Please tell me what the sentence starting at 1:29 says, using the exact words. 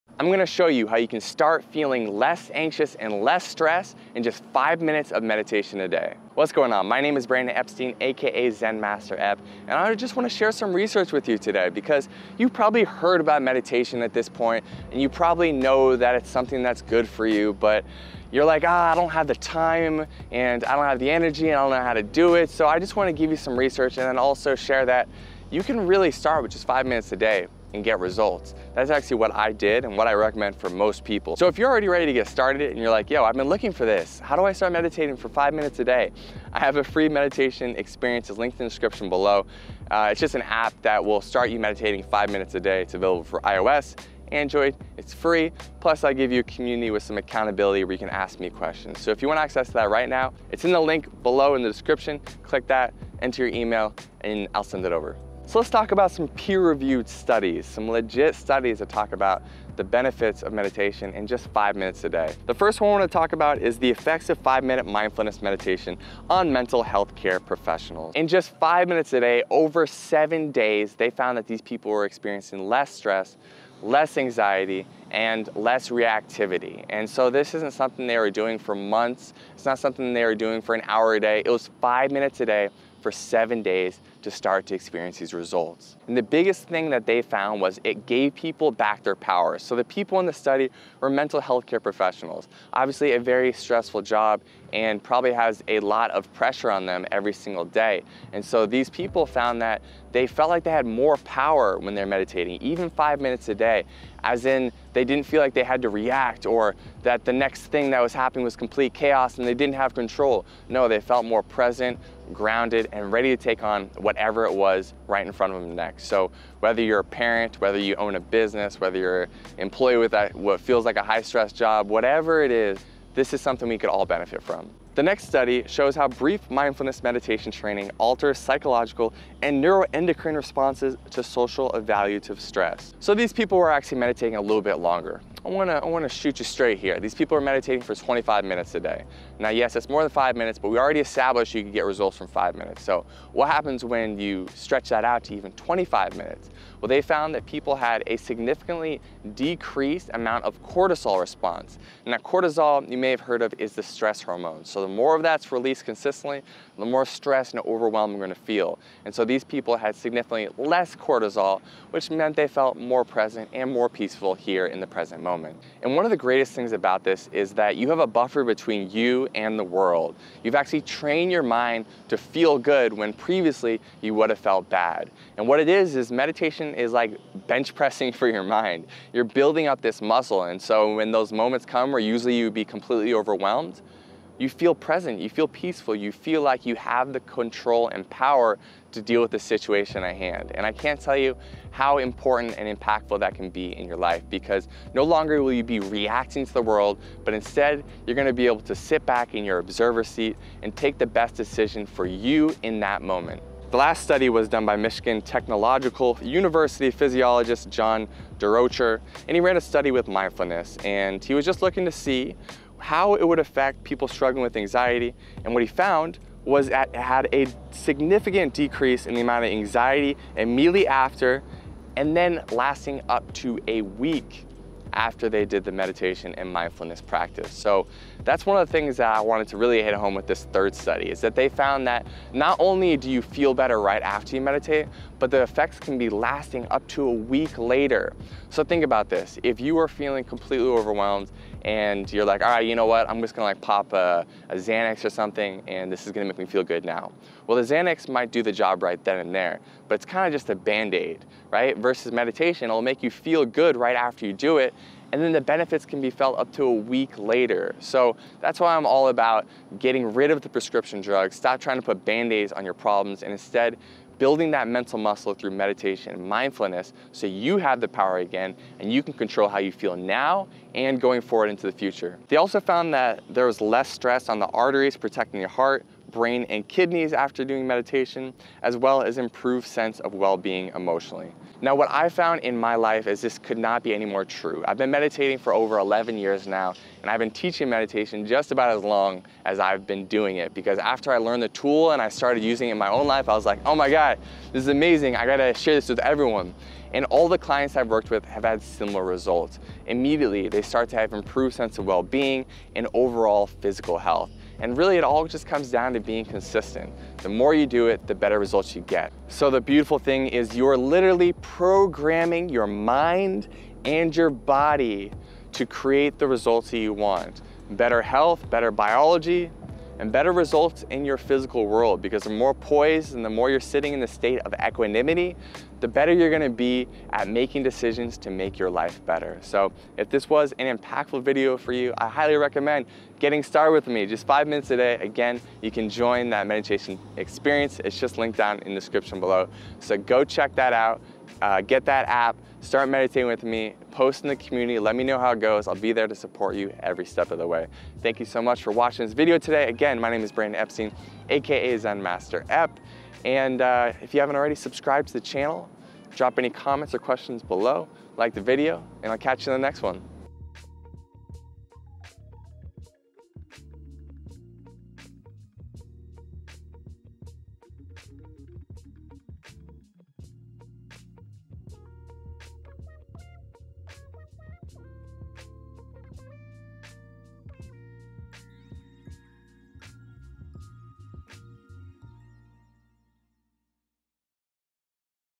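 So the people in the study were mental health care professionals.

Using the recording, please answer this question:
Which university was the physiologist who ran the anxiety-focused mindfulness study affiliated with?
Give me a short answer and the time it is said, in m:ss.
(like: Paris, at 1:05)
Michigan Technological University, at 3:24.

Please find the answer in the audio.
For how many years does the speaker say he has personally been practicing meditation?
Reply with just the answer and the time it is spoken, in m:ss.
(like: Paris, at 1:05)
Over 11, at 4:45.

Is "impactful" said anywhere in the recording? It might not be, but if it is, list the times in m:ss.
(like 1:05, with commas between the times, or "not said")
3:12, 5:30.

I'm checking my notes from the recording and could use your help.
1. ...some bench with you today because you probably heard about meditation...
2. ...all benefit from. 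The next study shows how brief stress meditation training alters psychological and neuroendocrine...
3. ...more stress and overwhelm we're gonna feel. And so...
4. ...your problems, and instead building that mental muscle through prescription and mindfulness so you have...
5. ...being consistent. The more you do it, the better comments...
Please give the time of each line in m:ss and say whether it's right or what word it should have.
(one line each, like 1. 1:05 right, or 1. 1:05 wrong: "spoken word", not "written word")
1. 0:10 wrong: "research", not "bench"
2. 2:03 wrong: "mindfulness", not "stress"
3. 2:36 right
4. 4:22 wrong: "meditation", not "prescription"
5. 5:05 wrong: "results", not "comments".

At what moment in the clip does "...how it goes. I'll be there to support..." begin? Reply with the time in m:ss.
5:45.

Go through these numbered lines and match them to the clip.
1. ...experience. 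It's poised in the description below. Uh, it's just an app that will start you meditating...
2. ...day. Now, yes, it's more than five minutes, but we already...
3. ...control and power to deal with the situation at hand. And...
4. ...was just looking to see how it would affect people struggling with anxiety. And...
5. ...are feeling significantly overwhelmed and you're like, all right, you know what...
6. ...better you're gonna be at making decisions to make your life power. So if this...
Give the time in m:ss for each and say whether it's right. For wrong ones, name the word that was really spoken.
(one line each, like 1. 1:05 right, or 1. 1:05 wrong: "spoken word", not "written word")
1. 0:37 wrong: "linked", not "poised"
2. 2:18 right
3. 3:07 right
4. 3:31 right
5. 3:59 wrong: "completely", not "significantly"
6. 5:25 wrong: "better", not "power".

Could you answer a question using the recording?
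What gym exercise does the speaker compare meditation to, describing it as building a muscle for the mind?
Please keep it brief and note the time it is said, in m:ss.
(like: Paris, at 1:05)
Bench pressing, at 2:57.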